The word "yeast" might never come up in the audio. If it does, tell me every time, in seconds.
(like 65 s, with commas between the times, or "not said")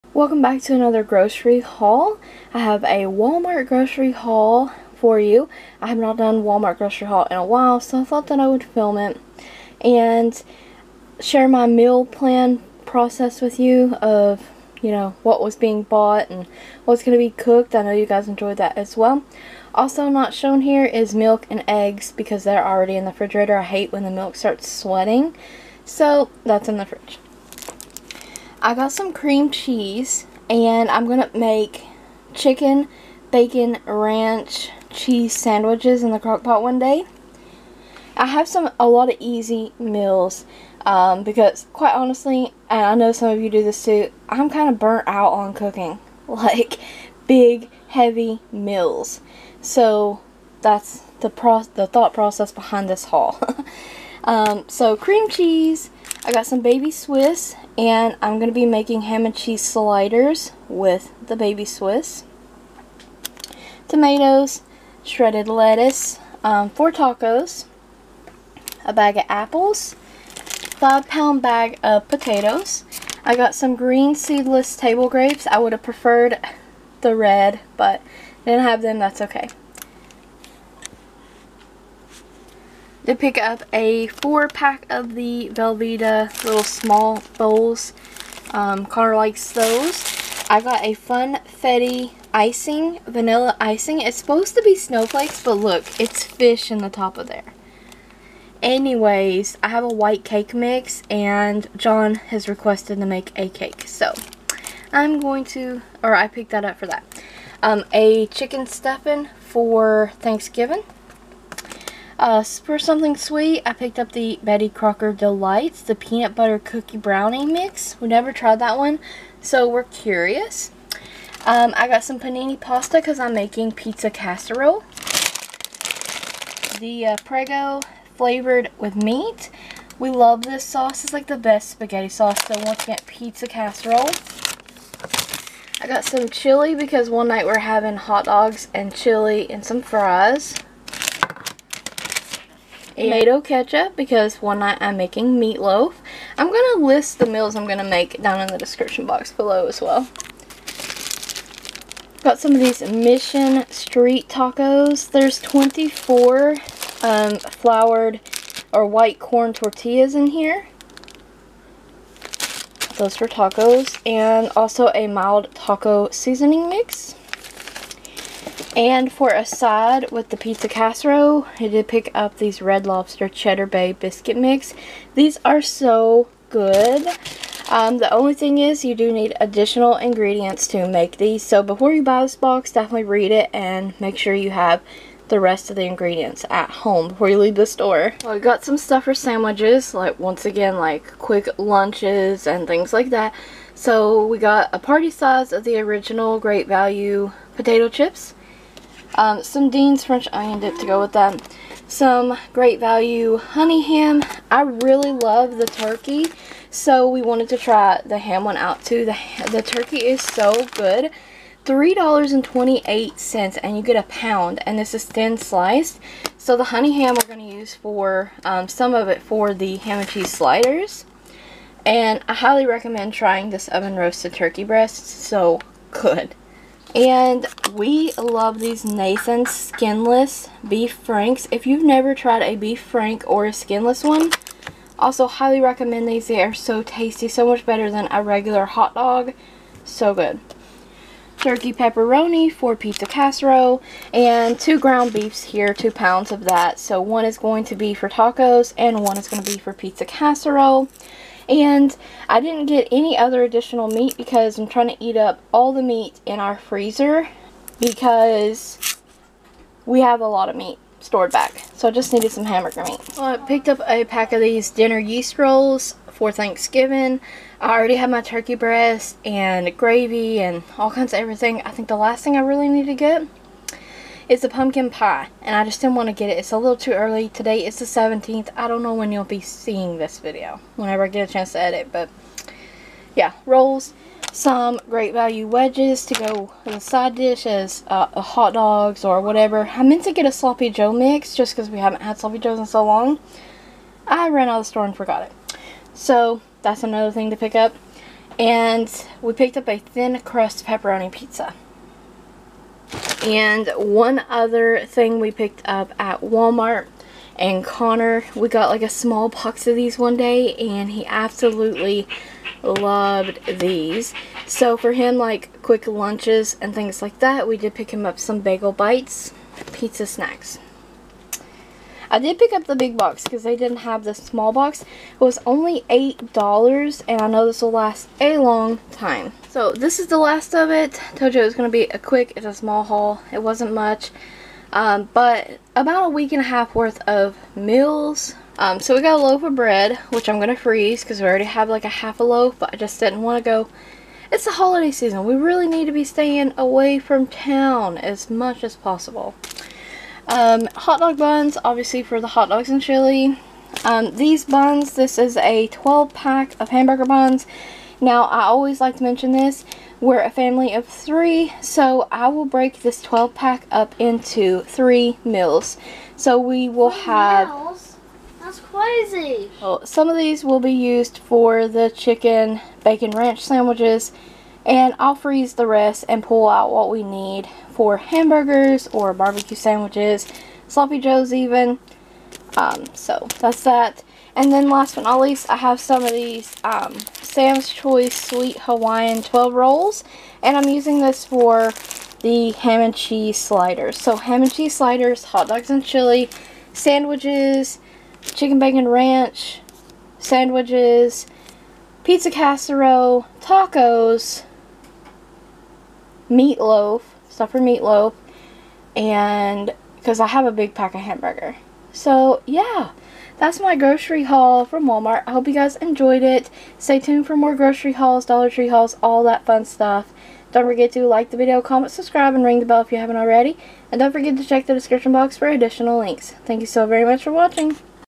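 264 s.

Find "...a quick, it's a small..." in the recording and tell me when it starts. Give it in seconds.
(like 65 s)
331 s.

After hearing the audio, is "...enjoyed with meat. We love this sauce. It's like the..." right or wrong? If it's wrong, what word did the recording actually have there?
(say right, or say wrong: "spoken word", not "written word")
wrong: "flavored", not "enjoyed".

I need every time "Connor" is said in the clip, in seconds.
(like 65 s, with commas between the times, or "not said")
88 s, 307 s.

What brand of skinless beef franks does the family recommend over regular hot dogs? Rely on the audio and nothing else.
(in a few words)
Nathan's.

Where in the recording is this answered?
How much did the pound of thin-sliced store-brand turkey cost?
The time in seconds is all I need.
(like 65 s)
211 s.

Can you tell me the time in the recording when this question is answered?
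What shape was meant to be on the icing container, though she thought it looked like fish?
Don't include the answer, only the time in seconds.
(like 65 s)
94 s.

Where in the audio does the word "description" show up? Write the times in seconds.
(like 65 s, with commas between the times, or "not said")
148 s, 424 s.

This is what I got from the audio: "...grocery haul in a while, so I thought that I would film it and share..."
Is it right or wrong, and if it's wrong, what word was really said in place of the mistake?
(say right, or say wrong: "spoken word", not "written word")
right.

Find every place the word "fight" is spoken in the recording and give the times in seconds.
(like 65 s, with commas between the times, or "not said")
not said.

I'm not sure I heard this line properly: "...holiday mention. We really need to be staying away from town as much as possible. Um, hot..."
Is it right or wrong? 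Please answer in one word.
wrong.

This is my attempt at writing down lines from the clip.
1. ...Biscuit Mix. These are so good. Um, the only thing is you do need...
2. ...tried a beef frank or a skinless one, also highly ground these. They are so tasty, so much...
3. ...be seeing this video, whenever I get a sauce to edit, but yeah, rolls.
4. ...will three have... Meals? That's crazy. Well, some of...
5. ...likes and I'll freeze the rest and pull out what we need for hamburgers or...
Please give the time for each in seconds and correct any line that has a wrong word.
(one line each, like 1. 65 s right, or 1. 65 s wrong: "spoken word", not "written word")
1. 173 s right
2. 232 s wrong: "recommend", not "ground"
3. 279 s wrong: "chance", not "sauce"
4. 366 s right
5. 373 s wrong: "sandwiches", not "likes".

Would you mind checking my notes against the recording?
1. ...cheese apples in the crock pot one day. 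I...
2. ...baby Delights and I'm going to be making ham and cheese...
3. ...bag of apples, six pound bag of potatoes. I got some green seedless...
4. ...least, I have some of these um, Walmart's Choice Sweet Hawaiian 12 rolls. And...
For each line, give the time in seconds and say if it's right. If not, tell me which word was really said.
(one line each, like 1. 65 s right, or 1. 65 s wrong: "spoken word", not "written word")
1. 34 s wrong: "sandwiches", not "apples"
2. 56 s wrong: "Swiss", not "Delights"
3. 68 s wrong: "five", not "six"
4. 385 s wrong: "Sam", not "Walmart".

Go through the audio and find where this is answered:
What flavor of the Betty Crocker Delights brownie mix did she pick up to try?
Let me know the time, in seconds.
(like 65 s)
115 s.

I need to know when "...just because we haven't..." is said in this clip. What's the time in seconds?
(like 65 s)
291 s.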